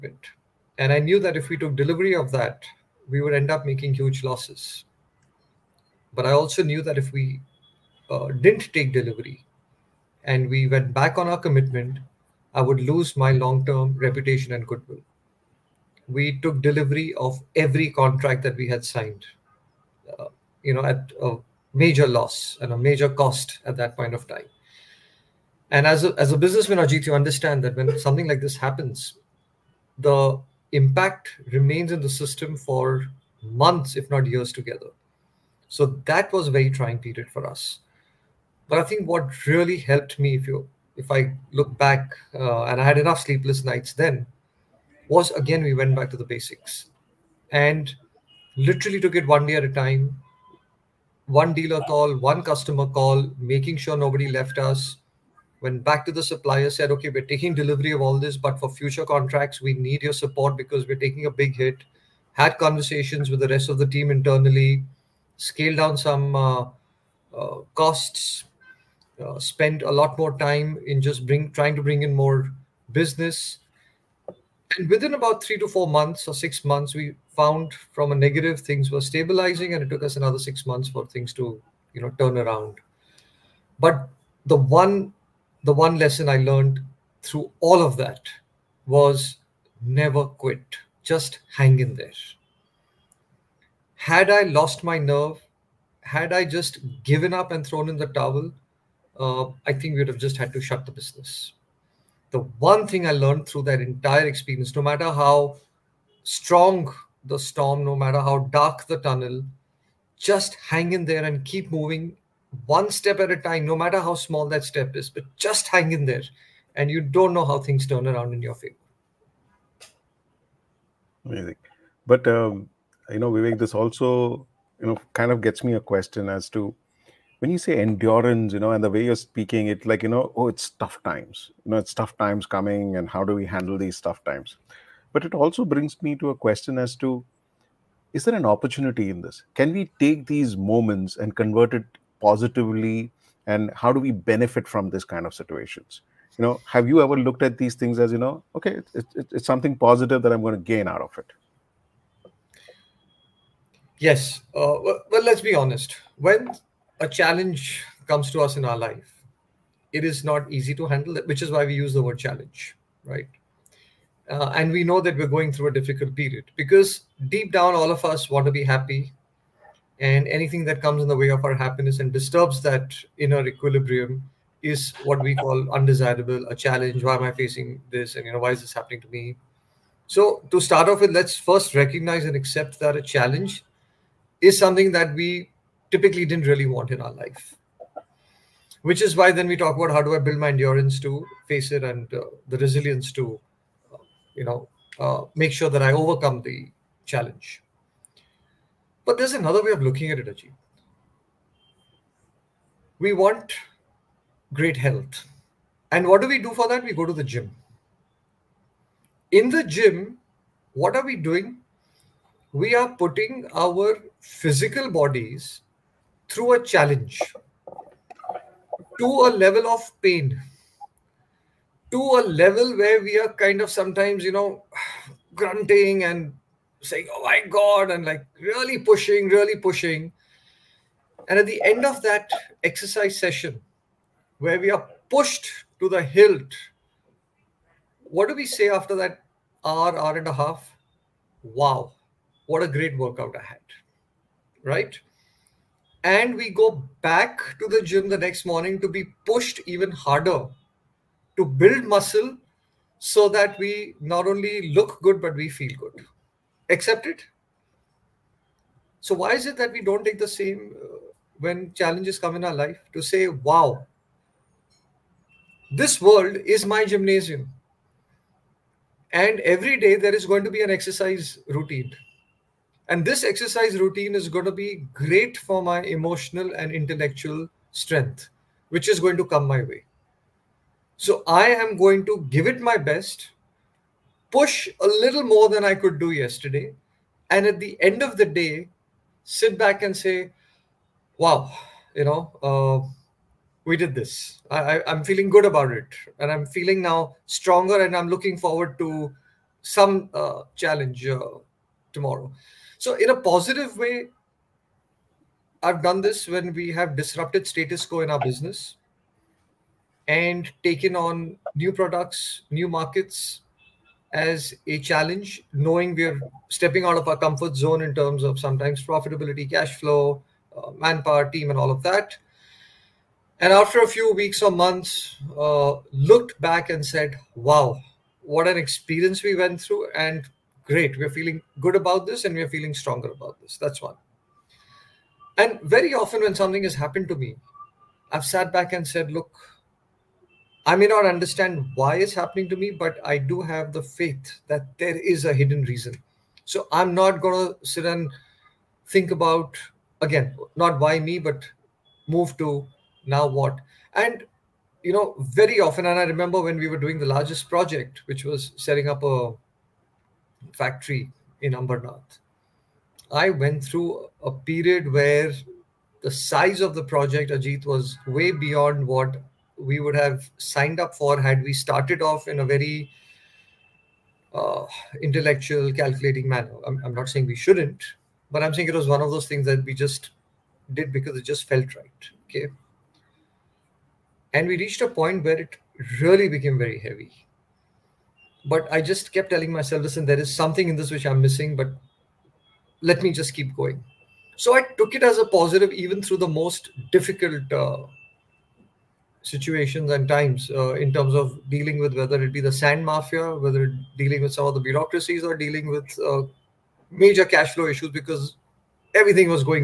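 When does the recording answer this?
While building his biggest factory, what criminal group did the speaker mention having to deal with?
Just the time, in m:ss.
6:42.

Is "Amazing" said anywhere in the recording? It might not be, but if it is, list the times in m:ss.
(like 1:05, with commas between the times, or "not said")
2:01.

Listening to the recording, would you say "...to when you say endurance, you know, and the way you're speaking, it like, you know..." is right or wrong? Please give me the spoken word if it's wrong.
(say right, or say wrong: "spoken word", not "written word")
right.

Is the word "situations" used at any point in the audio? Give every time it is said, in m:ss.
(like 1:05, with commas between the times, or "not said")
2:25, 6:39.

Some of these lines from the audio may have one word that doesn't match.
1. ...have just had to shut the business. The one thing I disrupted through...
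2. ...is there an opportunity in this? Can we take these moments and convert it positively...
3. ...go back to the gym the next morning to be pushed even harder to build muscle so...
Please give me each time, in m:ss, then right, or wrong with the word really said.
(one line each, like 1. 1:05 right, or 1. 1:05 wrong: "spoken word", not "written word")
1. 1:40 wrong: "learned", not "disrupted"
2. 2:18 right
3. 4:06 right.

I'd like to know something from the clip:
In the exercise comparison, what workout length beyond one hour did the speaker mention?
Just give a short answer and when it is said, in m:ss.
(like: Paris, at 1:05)
Hour and a half, at 3:59.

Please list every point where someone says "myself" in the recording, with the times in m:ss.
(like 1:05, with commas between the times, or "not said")
6:29.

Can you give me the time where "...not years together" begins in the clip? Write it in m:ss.
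0:34.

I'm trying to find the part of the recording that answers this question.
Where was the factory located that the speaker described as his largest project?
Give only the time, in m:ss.
6:01.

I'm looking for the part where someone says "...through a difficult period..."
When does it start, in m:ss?
2:45.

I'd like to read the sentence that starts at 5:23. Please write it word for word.
And after a few weeks or months, uh, looked back and said, wow, what an experience we went through.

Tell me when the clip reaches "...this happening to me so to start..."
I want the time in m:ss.
2:58.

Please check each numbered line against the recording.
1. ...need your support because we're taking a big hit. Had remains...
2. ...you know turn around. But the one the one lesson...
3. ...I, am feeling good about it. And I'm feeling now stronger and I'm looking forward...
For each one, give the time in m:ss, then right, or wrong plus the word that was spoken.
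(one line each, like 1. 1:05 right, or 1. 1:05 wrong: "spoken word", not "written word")
1. 0:59 wrong: "conversations", not "remains"
2. 1:21 right
3. 4:54 right.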